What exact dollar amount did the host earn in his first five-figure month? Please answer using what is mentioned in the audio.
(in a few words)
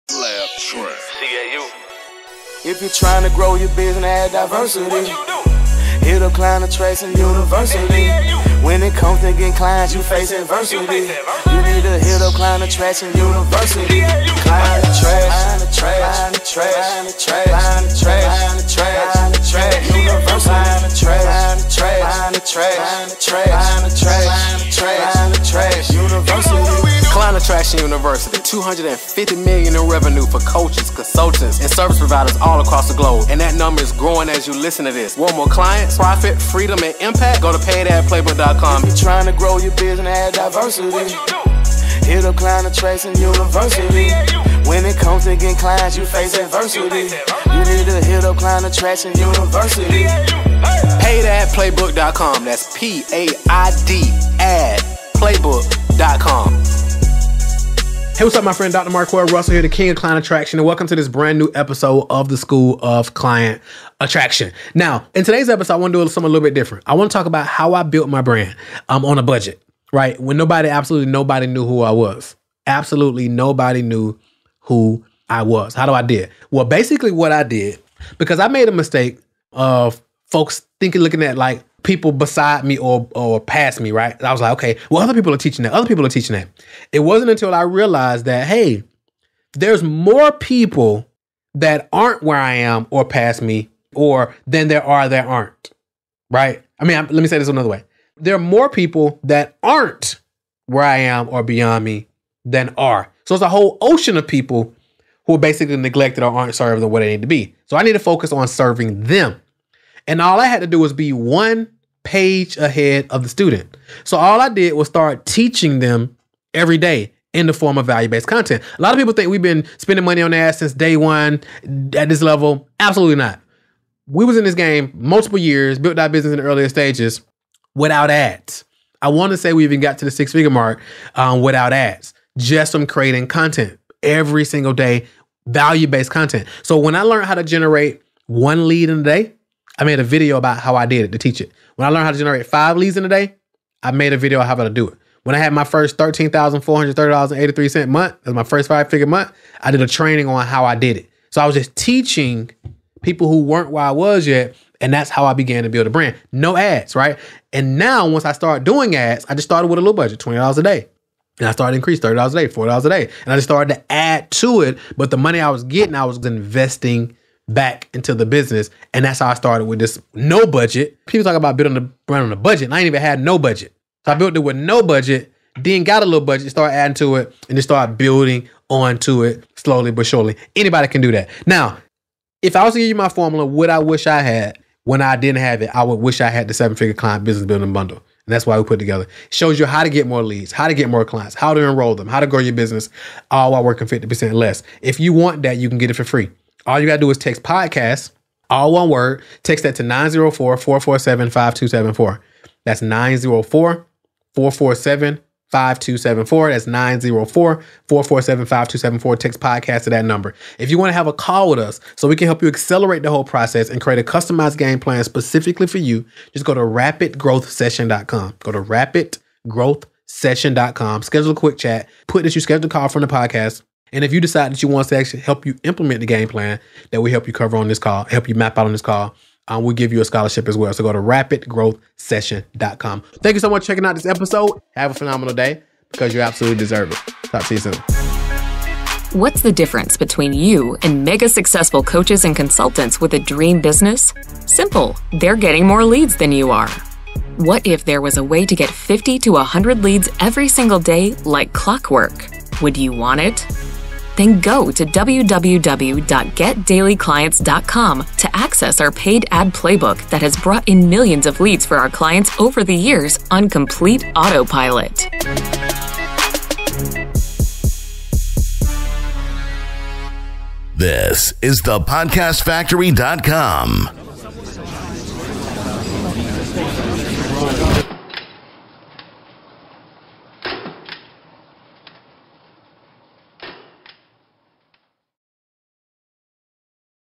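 $13,430.83.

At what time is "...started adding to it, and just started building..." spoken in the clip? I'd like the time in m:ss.
2:56.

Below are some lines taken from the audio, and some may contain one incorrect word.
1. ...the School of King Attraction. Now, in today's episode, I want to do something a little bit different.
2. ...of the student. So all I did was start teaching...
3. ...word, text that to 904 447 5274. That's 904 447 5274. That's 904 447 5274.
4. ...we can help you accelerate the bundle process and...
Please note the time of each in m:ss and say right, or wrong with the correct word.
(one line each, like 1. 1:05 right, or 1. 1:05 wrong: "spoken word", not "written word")
1. 1:02 wrong: "Client", not "King"
2. 1:53 right
3. 3:18 right
4. 3:32 wrong: "whole", not "bundle".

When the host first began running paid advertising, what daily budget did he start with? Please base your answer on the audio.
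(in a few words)
$20 a day.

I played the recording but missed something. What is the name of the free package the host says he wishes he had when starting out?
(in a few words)
seven figure client business building bundle.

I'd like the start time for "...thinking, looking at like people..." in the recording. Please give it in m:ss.
1:20.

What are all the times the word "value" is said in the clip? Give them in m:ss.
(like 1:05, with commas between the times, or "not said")
1:57, 2:15.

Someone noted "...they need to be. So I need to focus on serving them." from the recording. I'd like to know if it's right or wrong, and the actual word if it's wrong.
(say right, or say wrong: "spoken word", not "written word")
right.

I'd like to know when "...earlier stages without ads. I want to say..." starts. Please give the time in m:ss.
2:06.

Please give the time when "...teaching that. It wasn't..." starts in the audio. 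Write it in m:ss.
1:26.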